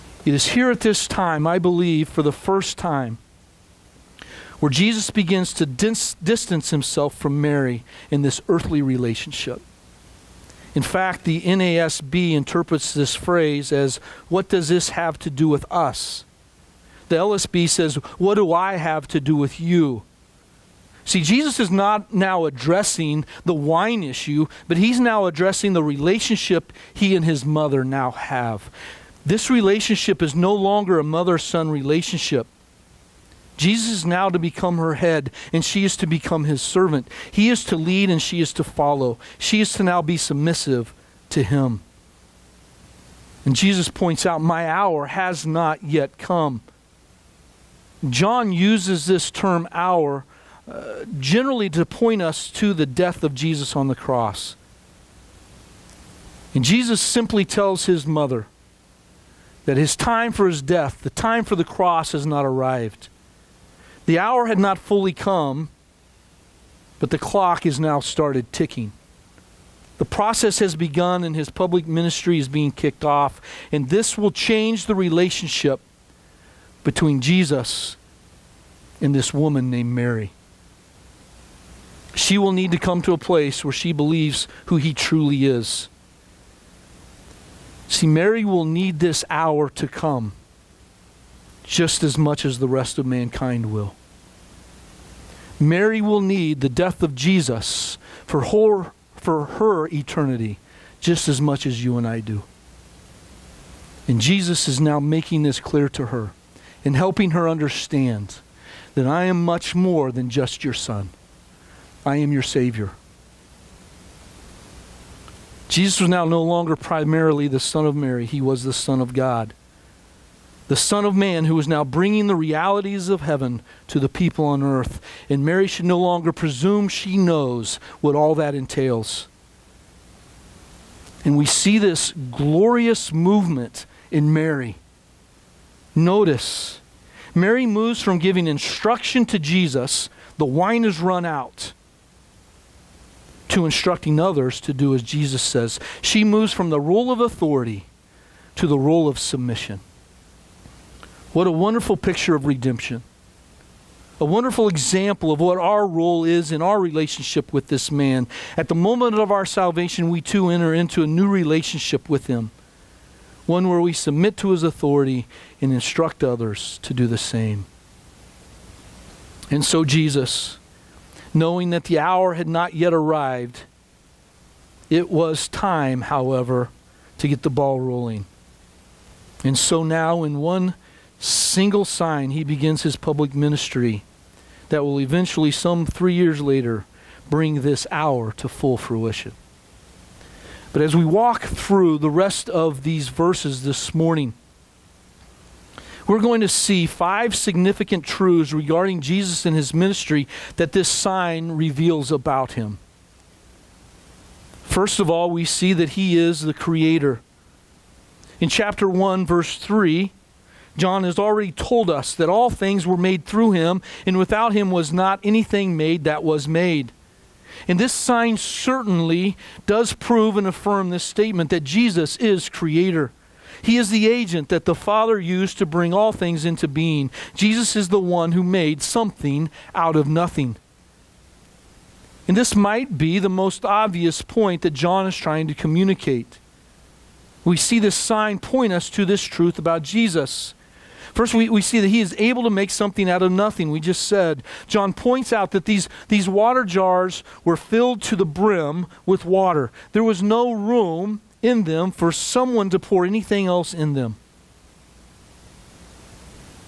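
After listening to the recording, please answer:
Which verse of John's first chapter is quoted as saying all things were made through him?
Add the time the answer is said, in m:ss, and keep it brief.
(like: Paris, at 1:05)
Verse 3, at 3:29.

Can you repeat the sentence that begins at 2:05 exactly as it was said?
And Mary should no longer presume she knows what all that entails.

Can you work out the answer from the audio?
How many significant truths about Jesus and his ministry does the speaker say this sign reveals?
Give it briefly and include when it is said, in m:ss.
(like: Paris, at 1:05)
5, at 3:16.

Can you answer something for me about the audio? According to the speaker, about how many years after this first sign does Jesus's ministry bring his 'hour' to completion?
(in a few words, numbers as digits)
3.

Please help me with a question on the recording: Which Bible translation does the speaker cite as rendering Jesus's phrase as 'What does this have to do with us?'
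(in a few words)
NASB.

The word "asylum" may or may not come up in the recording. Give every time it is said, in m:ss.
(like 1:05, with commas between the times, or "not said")
not said.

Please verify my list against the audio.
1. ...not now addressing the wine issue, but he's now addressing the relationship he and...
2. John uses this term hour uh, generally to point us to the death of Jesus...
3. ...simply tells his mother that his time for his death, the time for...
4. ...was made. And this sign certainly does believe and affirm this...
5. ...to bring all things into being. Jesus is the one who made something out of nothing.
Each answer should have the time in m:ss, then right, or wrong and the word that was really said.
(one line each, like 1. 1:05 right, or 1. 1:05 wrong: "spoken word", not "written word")
1. 0:21 right
2. 0:48 right
3. 0:56 right
4. 3:36 wrong: "prove", not "believe"
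5. 3:45 right.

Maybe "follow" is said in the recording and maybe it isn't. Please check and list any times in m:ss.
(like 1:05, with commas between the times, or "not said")
0:38.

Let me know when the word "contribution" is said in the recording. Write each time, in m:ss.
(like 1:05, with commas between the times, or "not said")
not said.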